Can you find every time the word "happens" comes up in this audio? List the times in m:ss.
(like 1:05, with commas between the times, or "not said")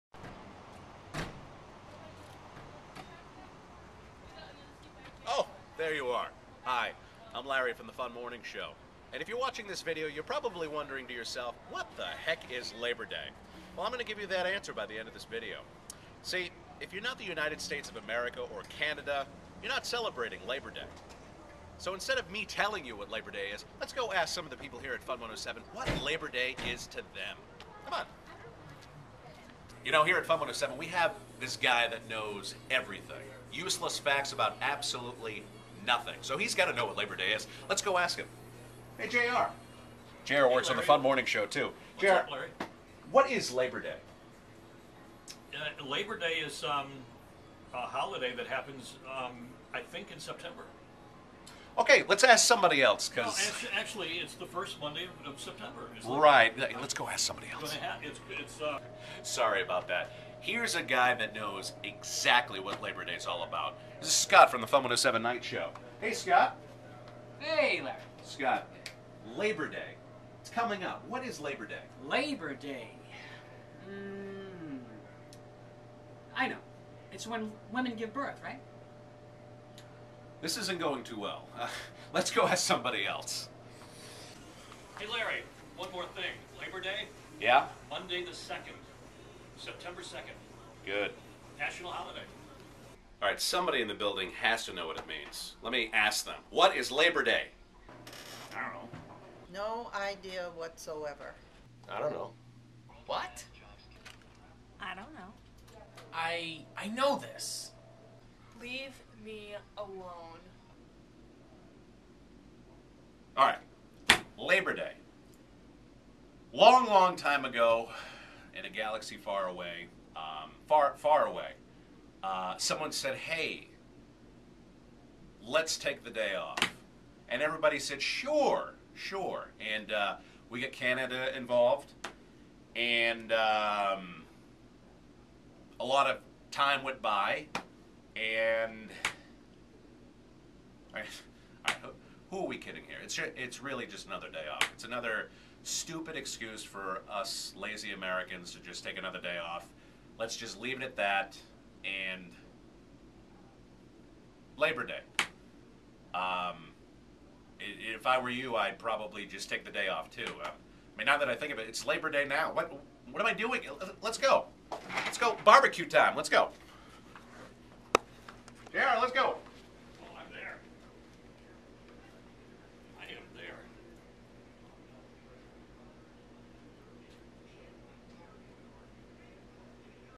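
0:48.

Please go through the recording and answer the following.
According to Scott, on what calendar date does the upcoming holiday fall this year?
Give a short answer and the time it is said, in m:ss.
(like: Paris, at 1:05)
September 2nd, at 1:29.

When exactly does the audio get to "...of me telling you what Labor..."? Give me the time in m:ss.
0:22.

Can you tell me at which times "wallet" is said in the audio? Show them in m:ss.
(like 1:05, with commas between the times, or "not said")
not said.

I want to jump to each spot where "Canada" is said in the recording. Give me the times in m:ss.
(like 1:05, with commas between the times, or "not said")
0:18, 2:10.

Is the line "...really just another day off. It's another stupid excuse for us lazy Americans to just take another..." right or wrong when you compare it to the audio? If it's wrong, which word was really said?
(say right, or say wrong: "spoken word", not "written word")
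right.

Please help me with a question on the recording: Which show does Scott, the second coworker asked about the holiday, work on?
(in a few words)
Fun 107 Night Show.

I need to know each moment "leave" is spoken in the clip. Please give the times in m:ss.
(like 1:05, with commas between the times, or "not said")
1:48, 2:30.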